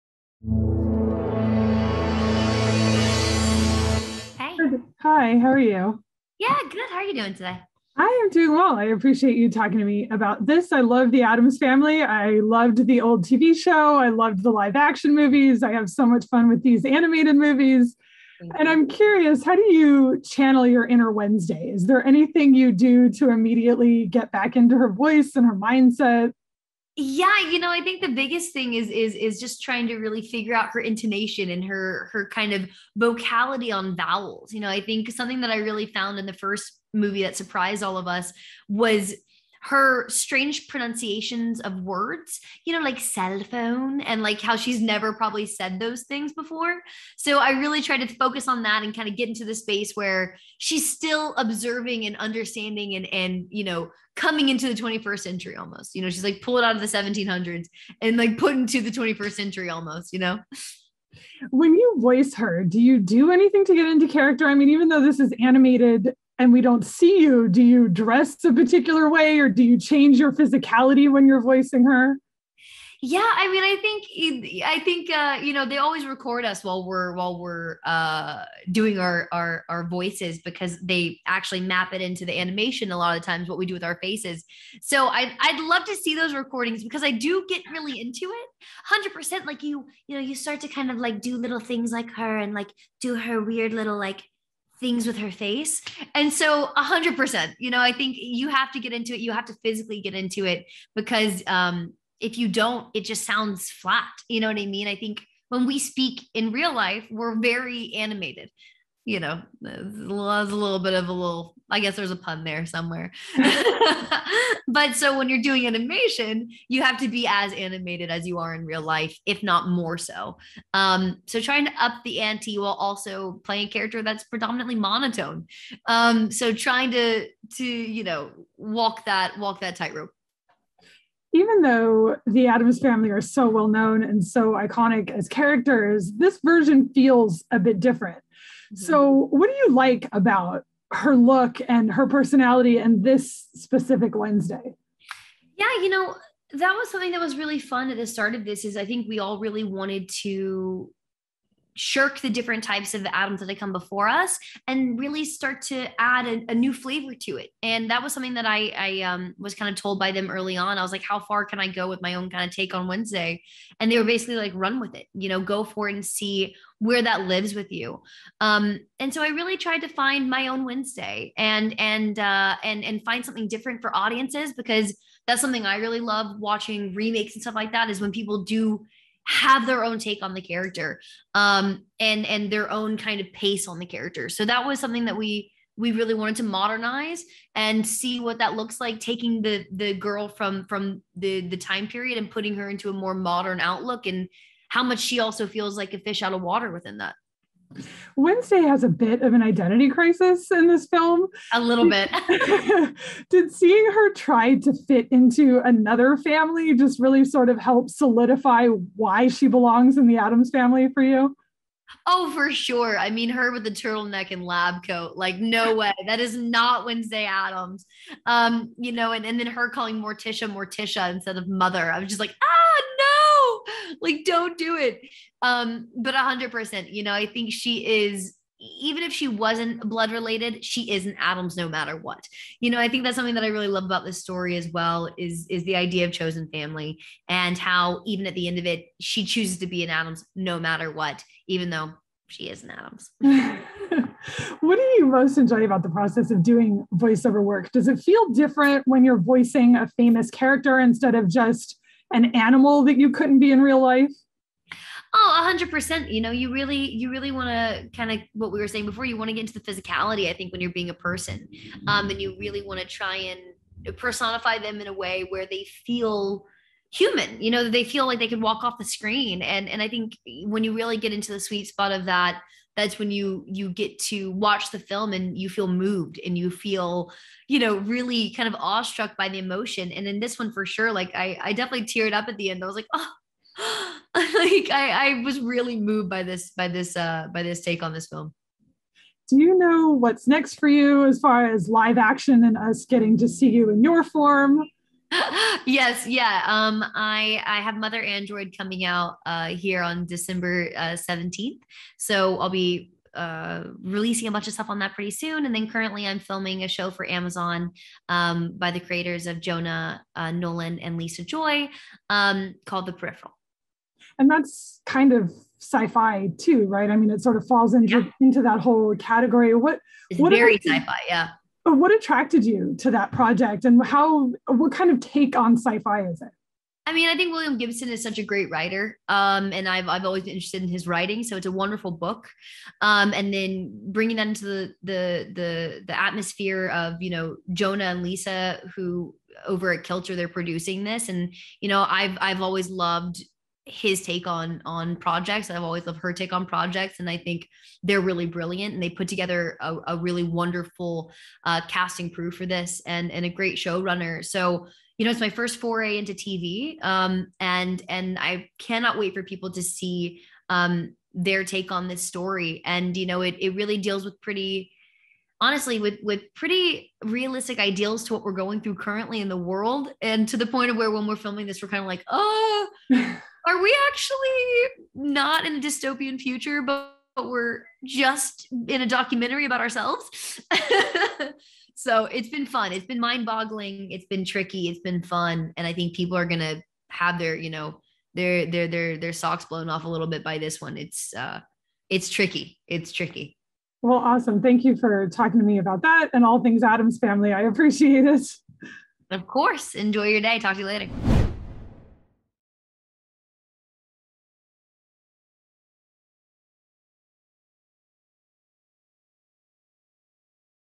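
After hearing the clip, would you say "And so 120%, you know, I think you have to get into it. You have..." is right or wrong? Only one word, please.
wrong.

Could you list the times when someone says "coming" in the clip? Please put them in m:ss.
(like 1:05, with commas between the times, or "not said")
0:54, 4:58.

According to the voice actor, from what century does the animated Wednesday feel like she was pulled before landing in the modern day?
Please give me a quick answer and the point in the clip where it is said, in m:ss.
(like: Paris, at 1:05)
1700s, at 0:56.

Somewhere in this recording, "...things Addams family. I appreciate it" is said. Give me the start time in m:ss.
6:36.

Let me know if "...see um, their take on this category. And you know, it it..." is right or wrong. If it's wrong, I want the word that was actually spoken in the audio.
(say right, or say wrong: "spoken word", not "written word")
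wrong: "story", not "category".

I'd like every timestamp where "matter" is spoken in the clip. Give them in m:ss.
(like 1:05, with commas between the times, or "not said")
3:51, 4:00.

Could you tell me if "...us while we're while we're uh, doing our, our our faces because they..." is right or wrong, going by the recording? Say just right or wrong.
wrong.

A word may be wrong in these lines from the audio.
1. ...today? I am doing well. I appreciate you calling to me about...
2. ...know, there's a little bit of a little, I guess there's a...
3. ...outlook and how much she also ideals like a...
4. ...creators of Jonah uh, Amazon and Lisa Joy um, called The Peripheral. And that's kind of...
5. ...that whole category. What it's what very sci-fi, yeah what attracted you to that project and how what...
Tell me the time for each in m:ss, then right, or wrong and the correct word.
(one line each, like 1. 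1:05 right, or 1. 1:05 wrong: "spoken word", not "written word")
1. 0:07 wrong: "talking", not "calling"
2. 1:49 right
3. 3:13 wrong: "feels", not "ideals"
4. 5:08 wrong: "Nolan", not "Amazon"
5. 5:18 right.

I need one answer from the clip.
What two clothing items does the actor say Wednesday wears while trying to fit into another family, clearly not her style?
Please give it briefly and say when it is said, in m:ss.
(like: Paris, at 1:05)
turtleneck and lab coat, at 3:33.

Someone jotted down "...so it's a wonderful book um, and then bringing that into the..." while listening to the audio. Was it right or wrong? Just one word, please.
right.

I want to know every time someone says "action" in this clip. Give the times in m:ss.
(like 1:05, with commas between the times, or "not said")
0:14, 4:51.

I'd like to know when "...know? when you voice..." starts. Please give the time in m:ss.
1:00.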